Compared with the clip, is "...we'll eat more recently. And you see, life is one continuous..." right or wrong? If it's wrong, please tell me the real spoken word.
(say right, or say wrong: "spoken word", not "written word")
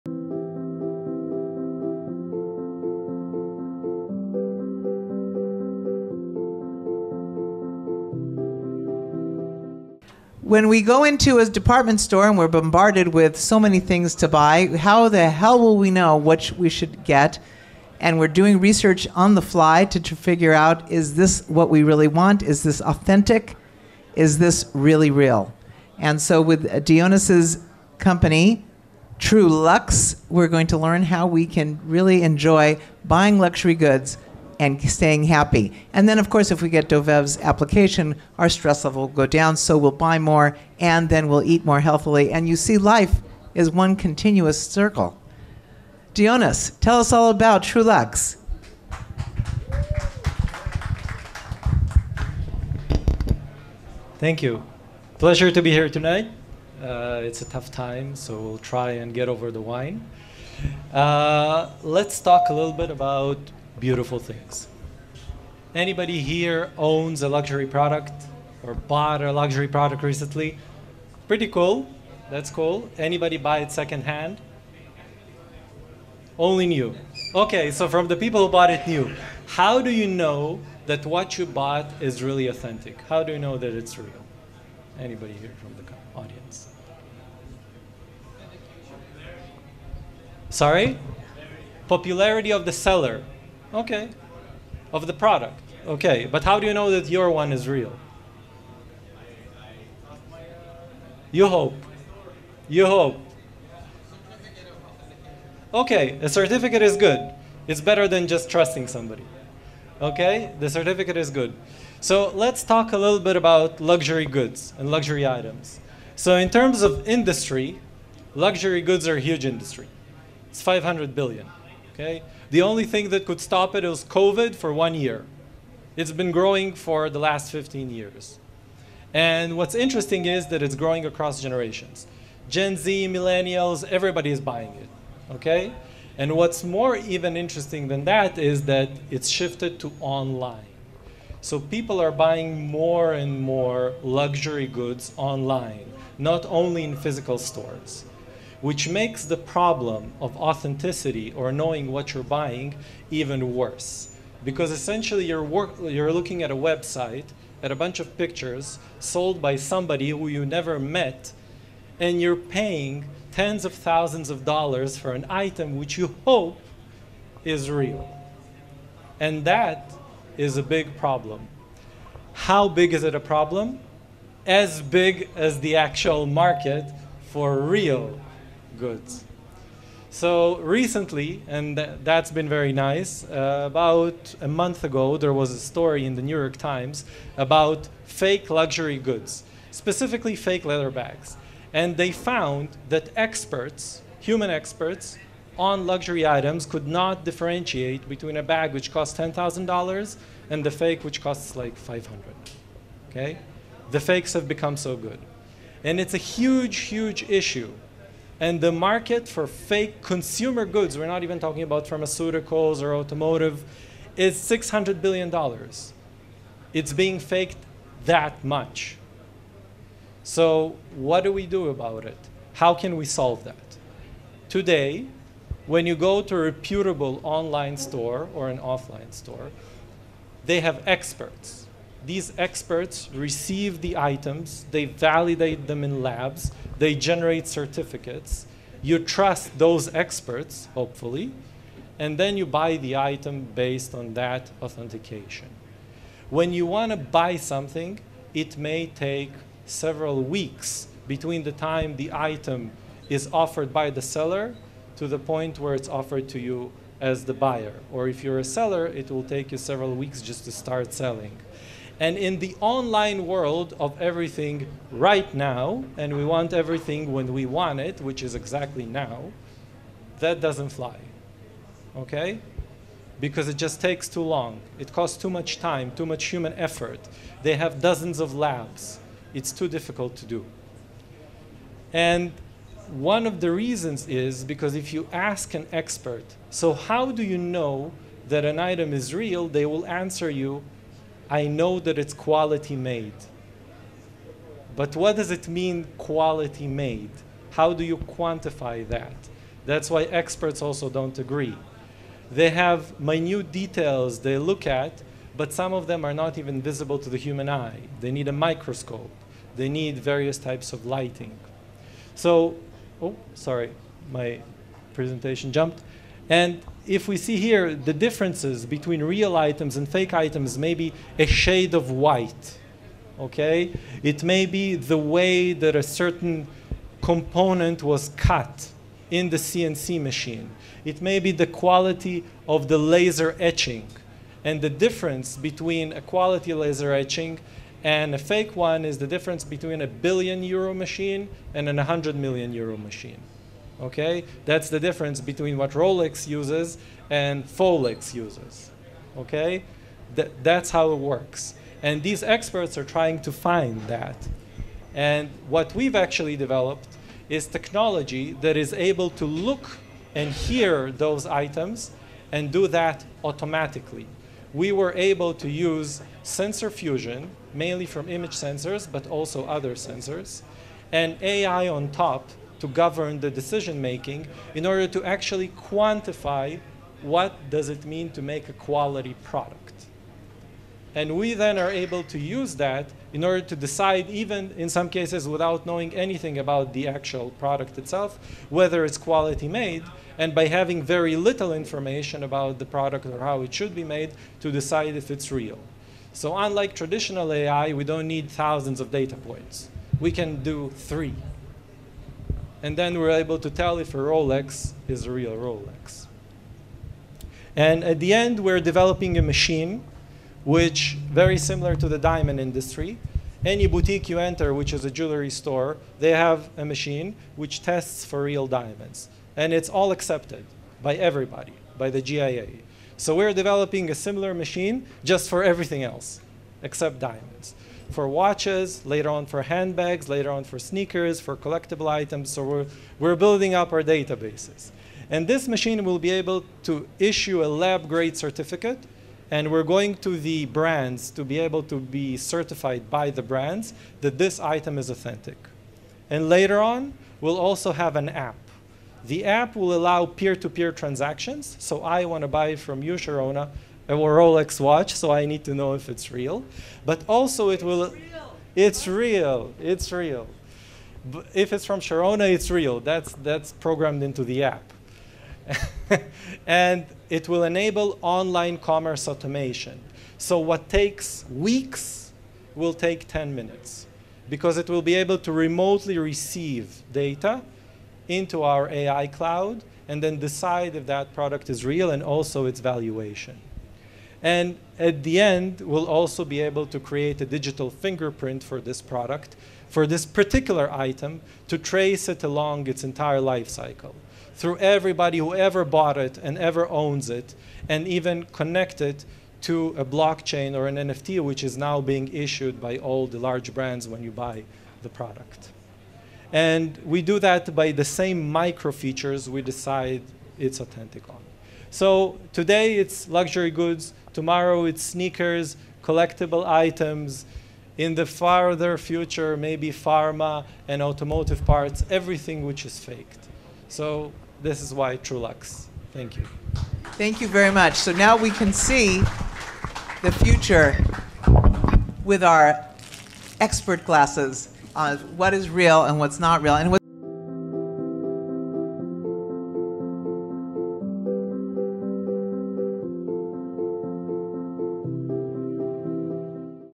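wrong: "healthily", not "recently".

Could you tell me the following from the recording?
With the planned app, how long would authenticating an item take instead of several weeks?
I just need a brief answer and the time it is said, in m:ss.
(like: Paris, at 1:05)
10 minutes, at 7:53.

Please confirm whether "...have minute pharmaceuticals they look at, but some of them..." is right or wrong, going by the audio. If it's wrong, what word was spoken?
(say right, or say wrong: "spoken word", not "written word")
wrong: "details", not "pharmaceuticals".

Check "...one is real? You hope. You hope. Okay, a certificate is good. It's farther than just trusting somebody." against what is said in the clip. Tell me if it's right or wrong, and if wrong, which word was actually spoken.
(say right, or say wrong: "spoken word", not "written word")
wrong: "better", not "farther".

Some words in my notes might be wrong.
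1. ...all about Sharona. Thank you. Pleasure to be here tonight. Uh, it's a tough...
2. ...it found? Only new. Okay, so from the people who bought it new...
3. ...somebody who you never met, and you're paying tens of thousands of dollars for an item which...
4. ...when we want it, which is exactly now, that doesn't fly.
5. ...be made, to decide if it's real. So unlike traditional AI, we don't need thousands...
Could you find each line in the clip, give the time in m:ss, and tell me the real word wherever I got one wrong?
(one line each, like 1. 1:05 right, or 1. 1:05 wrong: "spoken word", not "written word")
1. 0:47 wrong: "Trulux", not "Sharona"
2. 1:13 wrong: "secondhand", not "found"
3. 2:39 right
4. 4:27 right
5. 6:33 right.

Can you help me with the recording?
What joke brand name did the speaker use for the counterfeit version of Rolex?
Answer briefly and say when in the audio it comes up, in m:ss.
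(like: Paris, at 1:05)
Folex, at 5:47.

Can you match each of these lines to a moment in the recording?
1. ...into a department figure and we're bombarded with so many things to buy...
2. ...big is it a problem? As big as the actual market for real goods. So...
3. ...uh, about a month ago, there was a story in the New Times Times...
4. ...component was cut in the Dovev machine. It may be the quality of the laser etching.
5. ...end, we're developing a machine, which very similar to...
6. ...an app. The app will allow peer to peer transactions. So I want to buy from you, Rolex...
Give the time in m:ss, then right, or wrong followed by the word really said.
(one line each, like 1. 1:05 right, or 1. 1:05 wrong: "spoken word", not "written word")
1. 0:11 wrong: "store", not "figure"
2. 2:52 right
3. 3:03 wrong: "York", not "Times"
4. 5:27 wrong: "CNC", not "Dovev"
5. 6:48 right
6. 7:27 wrong: "Sharona", not "Rolex".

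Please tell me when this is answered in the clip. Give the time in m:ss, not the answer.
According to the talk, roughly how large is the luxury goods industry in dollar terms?
2:00.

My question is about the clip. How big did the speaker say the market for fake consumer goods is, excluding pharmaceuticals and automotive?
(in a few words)
$600 billion.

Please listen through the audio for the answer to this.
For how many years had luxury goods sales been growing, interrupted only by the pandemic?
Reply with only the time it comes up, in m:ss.
2:07.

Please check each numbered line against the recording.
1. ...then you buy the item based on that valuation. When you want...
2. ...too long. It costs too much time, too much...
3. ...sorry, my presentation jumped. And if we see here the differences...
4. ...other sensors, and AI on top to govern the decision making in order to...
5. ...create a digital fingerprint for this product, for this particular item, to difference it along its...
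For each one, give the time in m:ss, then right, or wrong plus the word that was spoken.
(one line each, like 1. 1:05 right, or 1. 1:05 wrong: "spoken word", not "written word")
1. 4:02 wrong: "authentication", not "valuation"
2. 4:34 right
3. 5:13 right
4. 6:09 right
5. 8:06 wrong: "trace", not "difference".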